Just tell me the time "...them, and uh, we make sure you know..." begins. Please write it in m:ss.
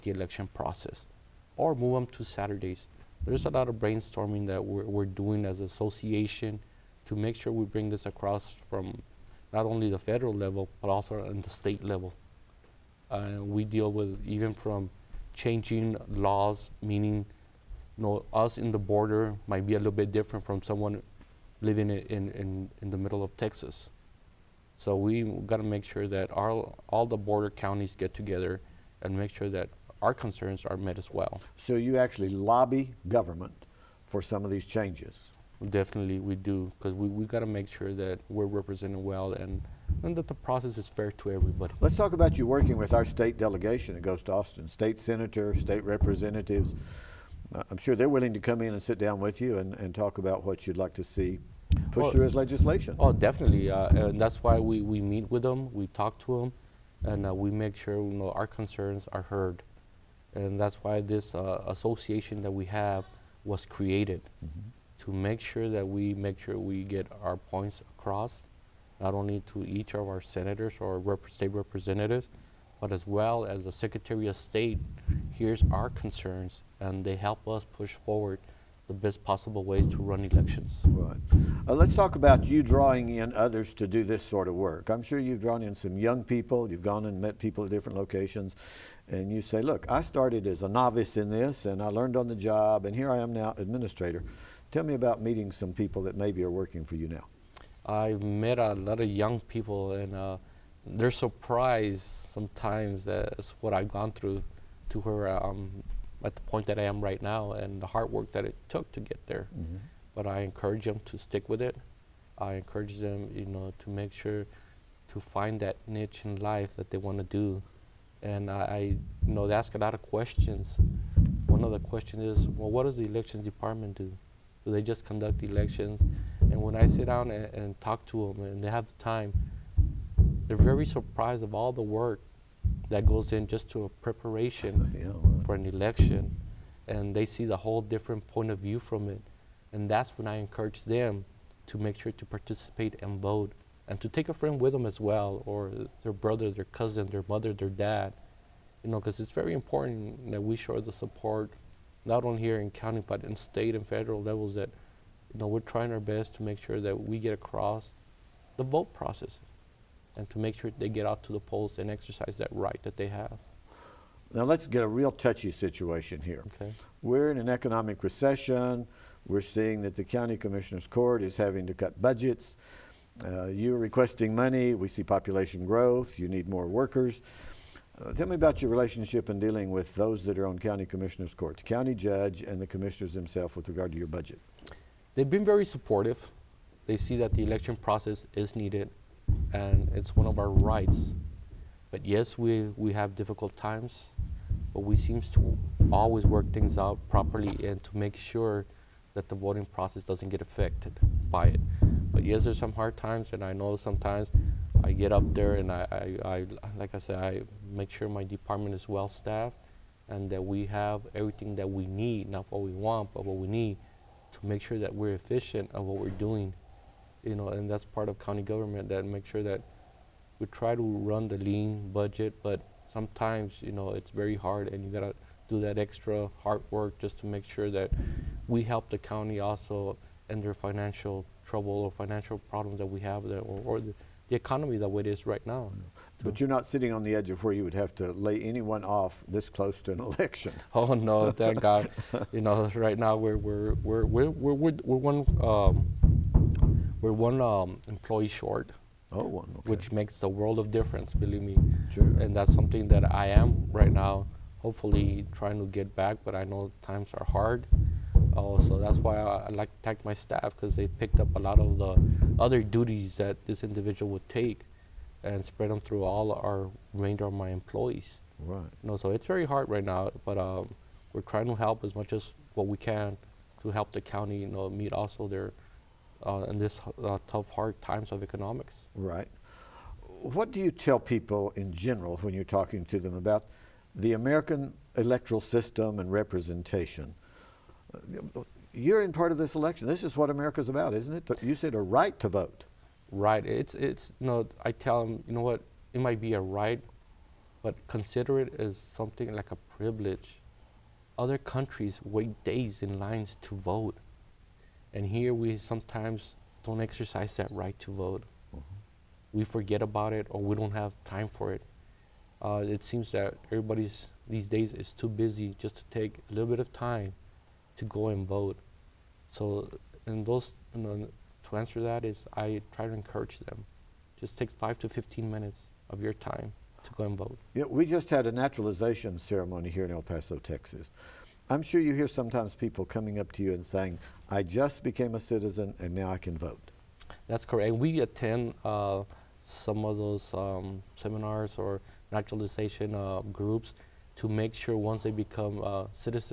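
0:56.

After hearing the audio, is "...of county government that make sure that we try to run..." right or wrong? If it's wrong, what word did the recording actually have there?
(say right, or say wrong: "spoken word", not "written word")
right.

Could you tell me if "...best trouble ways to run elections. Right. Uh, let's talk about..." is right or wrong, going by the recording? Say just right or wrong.
wrong.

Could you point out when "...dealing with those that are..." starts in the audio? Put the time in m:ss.
2:59.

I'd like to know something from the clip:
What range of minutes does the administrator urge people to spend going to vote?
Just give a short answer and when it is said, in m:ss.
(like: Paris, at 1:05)
5 to 15 minutes, at 5:24.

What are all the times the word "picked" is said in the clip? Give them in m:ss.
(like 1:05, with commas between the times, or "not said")
4:20.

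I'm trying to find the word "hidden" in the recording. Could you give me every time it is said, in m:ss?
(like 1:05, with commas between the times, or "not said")
not said.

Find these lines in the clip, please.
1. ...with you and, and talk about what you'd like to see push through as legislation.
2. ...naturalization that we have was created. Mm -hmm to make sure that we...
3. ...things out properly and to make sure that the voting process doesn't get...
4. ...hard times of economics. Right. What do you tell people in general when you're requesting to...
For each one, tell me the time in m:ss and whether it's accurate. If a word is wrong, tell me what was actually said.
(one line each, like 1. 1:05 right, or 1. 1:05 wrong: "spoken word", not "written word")
1. 0:49 right
2. 1:01 wrong: "association", not "naturalization"
3. 3:16 right
4. 4:37 wrong: "talking", not "requesting".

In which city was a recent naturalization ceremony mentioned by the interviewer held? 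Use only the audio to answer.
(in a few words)
El Paso, Texas.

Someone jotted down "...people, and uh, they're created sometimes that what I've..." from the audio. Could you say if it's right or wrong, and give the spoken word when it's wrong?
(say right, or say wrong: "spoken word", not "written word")
wrong: "surprised", not "created".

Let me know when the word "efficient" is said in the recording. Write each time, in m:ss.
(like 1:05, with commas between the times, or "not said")
3:35.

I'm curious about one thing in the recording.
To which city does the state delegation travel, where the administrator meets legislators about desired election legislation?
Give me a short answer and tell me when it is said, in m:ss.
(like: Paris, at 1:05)
Austin, at 0:44.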